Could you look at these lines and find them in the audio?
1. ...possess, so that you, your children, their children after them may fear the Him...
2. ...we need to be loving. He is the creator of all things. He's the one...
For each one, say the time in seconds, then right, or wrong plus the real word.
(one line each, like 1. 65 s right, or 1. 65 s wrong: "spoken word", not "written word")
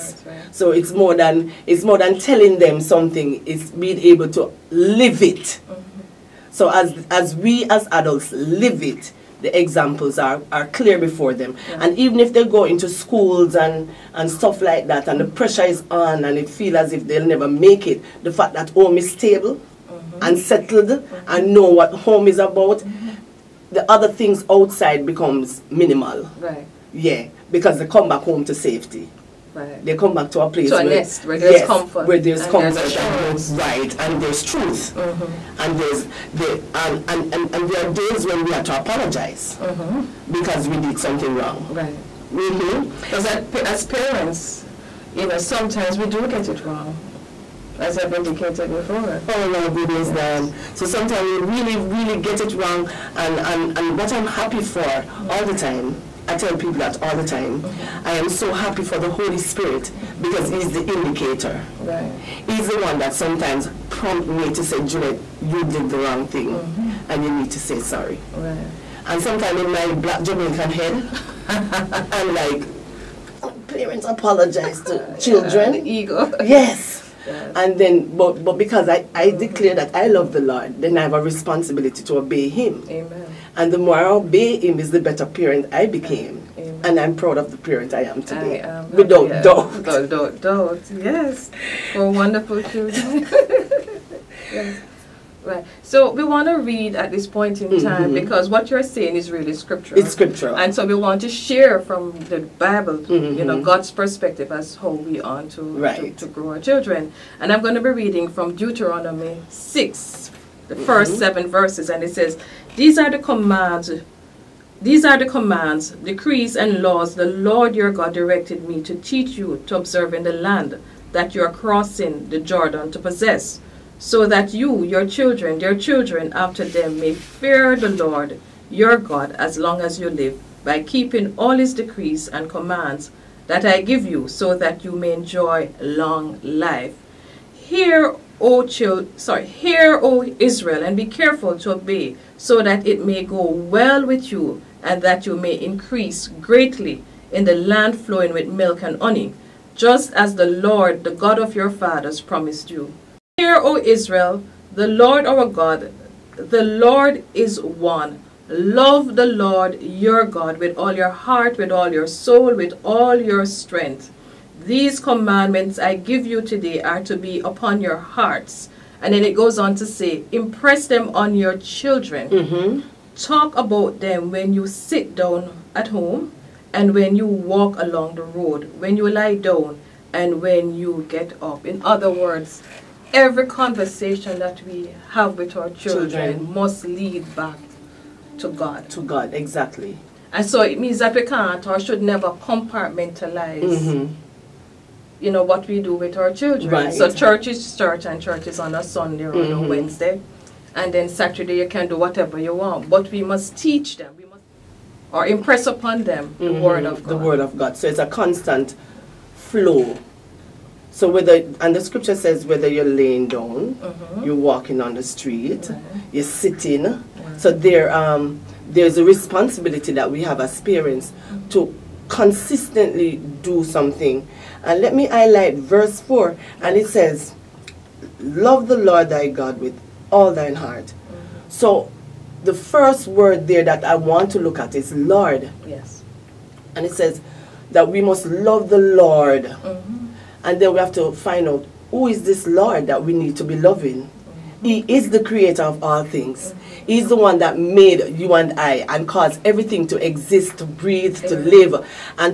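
1. 122 s wrong: "Lord", not "Him"
2. 243 s right.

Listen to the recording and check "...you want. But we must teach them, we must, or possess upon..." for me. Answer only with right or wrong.
wrong.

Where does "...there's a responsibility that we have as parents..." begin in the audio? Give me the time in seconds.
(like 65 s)
218 s.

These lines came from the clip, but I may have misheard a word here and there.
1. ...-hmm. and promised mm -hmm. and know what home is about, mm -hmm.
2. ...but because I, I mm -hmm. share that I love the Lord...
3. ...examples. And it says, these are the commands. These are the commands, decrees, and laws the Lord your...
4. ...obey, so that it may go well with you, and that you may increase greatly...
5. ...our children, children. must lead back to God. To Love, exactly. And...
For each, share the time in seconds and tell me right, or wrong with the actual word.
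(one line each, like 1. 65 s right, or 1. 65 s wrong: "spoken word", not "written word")
1. 19 s wrong: "settled", not "promised"
2. 78 s wrong: "declare", not "share"
3. 111 s wrong: "verses", not "examples"
4. 141 s right
5. 185 s wrong: "God", not "Love".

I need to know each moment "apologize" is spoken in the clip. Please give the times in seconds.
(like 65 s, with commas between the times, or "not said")
38 s, 74 s.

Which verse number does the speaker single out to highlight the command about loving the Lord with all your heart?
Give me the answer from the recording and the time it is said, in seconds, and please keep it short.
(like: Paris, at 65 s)
4, at 225 s.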